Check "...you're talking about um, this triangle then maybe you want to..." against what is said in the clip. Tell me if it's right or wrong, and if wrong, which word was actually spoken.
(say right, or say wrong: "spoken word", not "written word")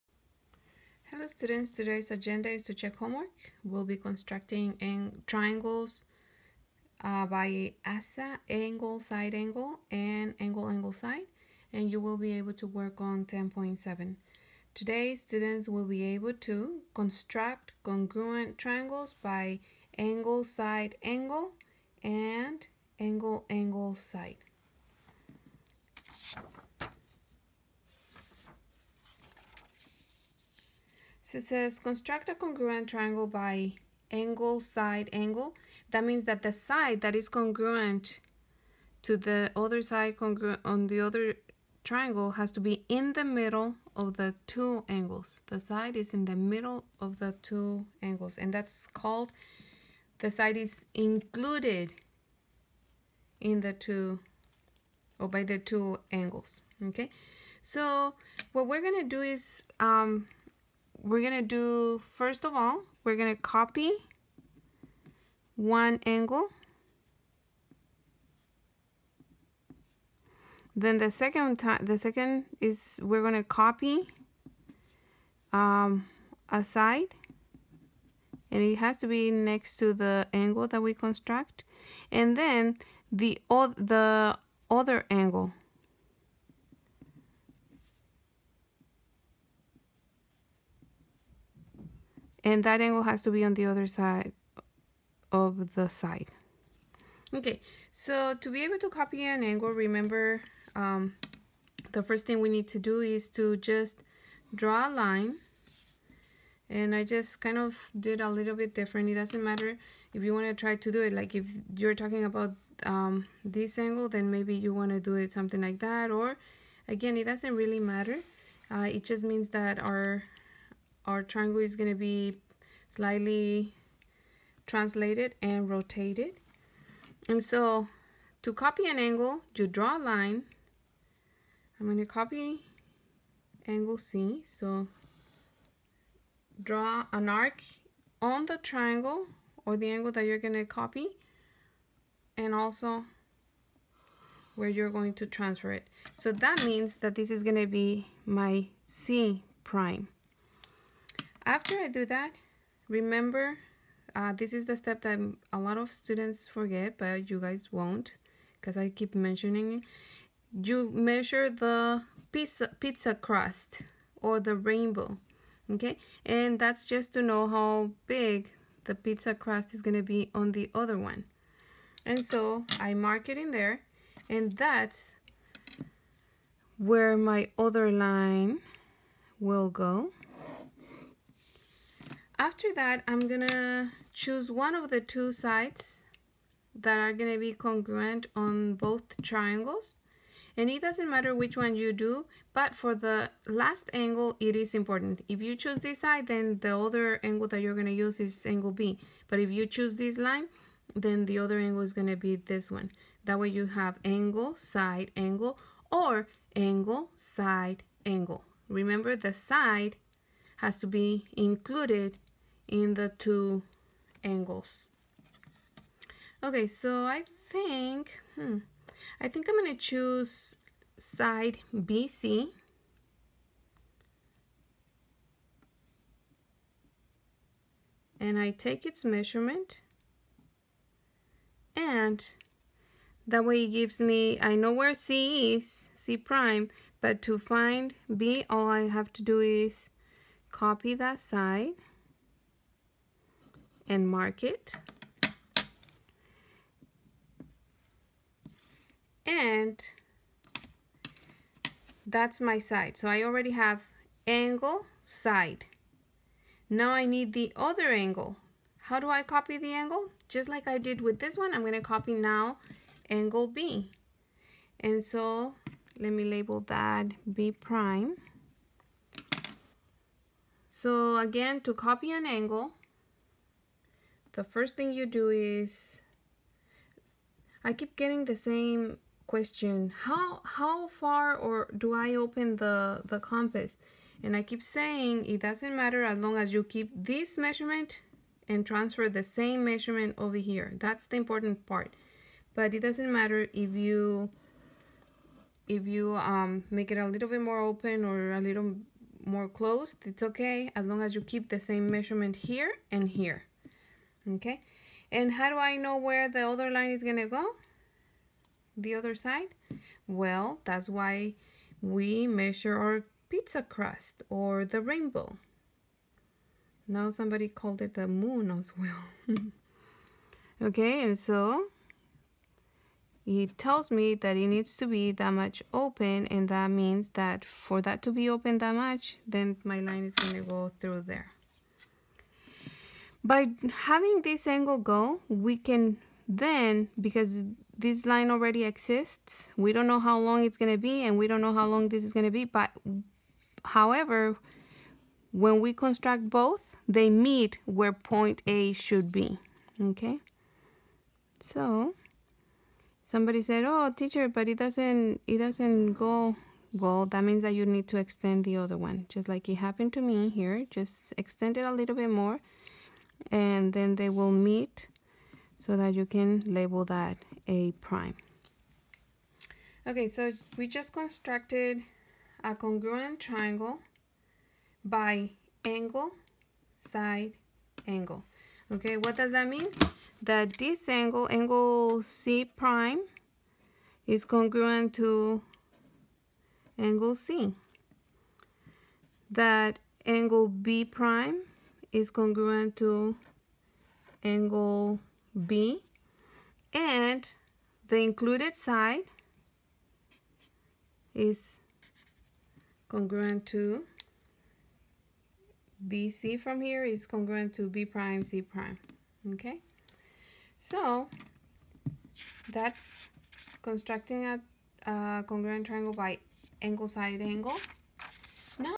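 wrong: "angle", not "triangle".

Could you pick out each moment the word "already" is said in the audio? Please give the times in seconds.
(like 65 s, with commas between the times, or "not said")
253 s, 338 s.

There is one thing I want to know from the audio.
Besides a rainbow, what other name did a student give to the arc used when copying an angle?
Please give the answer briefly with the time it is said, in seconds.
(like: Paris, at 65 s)
The moon, at 317 s.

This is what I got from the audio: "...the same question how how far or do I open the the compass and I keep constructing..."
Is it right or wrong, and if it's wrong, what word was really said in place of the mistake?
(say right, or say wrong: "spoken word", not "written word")
wrong: "saying", not "constructing".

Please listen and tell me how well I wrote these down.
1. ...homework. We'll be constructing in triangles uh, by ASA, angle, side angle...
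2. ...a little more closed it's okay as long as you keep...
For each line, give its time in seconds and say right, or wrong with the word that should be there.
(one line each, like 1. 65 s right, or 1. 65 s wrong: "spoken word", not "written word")
1. 2 s right
2. 298 s right.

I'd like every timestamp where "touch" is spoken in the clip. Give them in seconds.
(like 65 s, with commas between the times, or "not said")
not said.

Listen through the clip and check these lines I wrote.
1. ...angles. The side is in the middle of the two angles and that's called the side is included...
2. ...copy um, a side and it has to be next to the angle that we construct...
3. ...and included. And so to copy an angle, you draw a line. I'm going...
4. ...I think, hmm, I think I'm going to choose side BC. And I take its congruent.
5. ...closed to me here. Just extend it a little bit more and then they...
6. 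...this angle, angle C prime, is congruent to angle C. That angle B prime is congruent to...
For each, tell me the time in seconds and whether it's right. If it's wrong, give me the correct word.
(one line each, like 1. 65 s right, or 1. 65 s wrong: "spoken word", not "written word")
1. 44 s right
2. 73 s right
3. 125 s wrong: "rotated", not "included"
4. 217 s wrong: "measurement", not "congruent"
5. 359 s wrong: "happened", not "closed"
6. 380 s right.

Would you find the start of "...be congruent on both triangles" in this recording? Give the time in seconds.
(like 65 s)
187 s.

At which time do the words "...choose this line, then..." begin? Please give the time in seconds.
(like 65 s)
199 s.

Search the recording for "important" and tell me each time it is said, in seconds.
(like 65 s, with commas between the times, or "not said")
194 s, 291 s.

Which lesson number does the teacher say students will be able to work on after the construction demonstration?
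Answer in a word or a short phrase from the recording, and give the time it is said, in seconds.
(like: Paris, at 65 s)
10.7, at 13 s.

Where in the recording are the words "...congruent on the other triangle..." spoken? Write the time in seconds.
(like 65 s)
40 s.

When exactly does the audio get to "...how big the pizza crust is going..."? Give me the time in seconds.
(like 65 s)
167 s.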